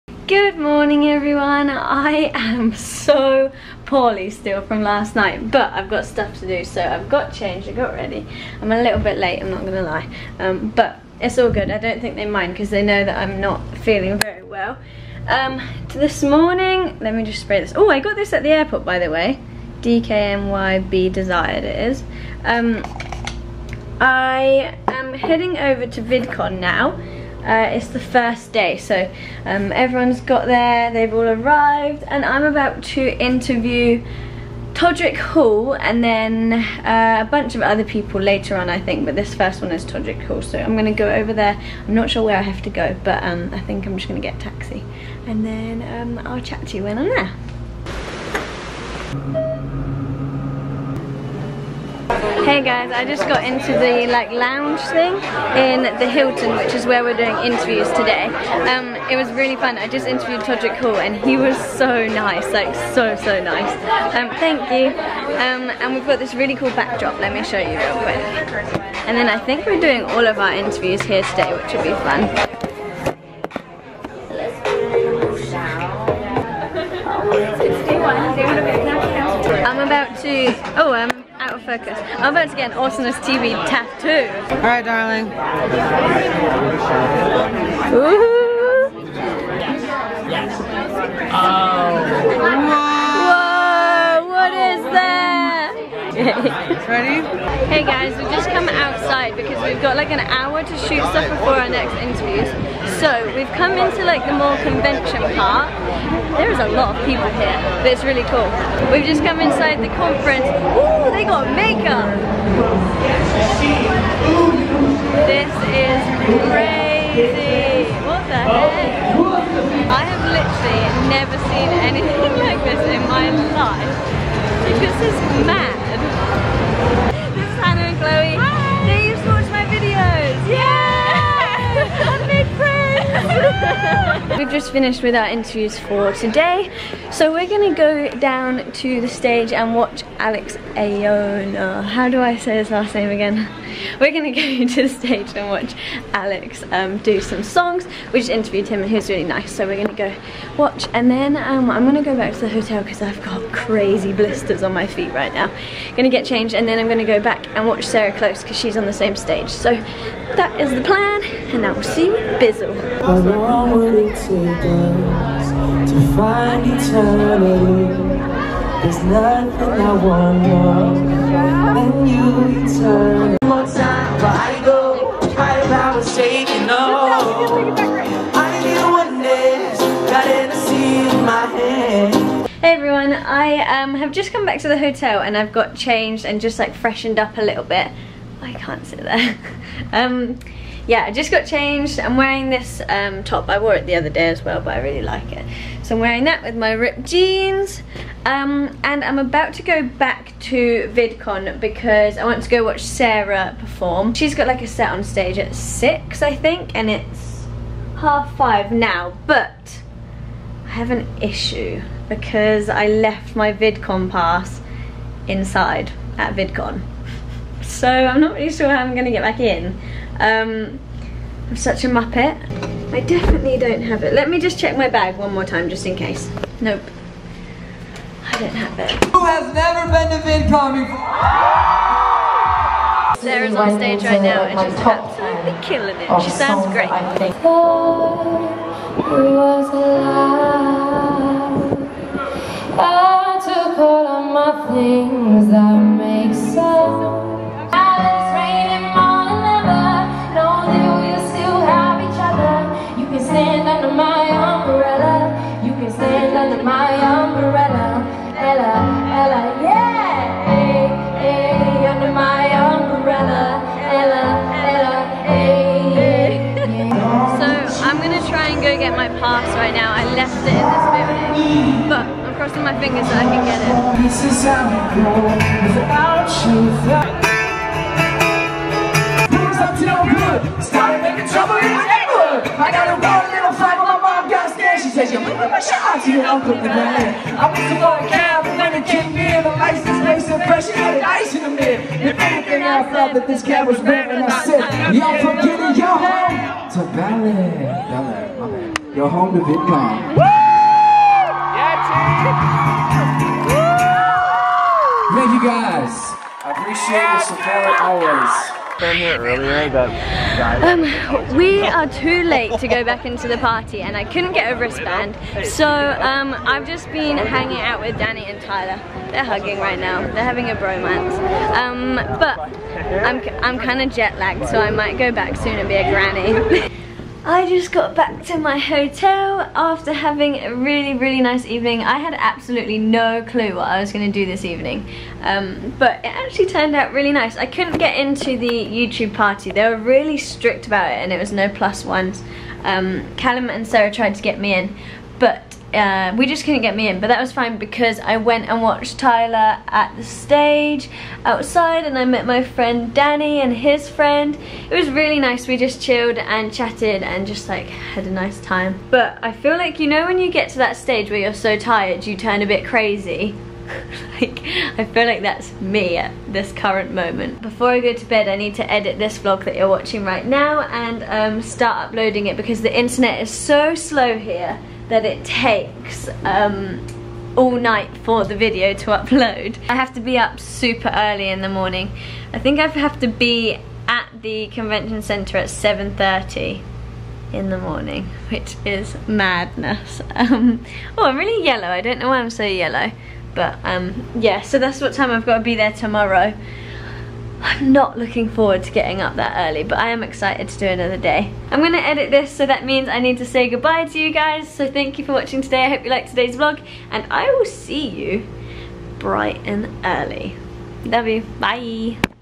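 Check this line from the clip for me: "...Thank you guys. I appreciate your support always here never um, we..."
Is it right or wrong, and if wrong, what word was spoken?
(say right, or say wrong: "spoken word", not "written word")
wrong: "earlier", not "never".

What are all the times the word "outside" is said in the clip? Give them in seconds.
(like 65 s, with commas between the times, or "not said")
98 s, 351 s.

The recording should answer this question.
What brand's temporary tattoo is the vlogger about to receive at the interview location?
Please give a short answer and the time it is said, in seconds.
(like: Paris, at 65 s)
Awesomeness TV, at 82 s.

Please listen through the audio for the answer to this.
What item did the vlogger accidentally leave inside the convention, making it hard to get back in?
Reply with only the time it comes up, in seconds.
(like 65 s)
213 s.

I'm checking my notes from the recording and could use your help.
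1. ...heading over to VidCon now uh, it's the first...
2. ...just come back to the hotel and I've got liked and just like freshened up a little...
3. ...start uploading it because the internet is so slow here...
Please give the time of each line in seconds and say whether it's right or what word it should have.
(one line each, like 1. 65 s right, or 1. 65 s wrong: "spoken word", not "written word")
1. 25 s right
2. 184 s wrong: "changed", not "liked"
3. 371 s right.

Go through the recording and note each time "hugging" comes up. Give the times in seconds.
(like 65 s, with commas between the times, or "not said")
319 s.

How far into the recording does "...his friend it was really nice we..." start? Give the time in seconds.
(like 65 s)
353 s.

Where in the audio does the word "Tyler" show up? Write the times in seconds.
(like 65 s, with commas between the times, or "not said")
318 s, 348 s.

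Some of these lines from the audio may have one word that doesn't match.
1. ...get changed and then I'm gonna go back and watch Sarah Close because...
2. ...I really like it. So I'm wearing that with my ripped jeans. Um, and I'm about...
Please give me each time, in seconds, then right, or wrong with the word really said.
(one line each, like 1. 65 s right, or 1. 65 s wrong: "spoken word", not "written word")
1. 156 s right
2. 194 s right.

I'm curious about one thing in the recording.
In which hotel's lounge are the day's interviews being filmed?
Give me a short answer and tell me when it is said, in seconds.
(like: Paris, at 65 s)
Hilton, at 56 s.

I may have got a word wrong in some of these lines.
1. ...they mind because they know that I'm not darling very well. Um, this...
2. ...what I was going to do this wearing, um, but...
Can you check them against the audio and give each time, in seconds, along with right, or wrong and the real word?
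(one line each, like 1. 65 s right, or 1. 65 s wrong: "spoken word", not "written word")
1. 12 s wrong: "feeling", not "darling"
2. 333 s wrong: "evening", not "wearing".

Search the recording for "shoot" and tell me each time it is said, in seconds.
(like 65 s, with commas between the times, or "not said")
100 s.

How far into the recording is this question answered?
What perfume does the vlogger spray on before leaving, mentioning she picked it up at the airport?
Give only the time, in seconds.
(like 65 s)
19 s.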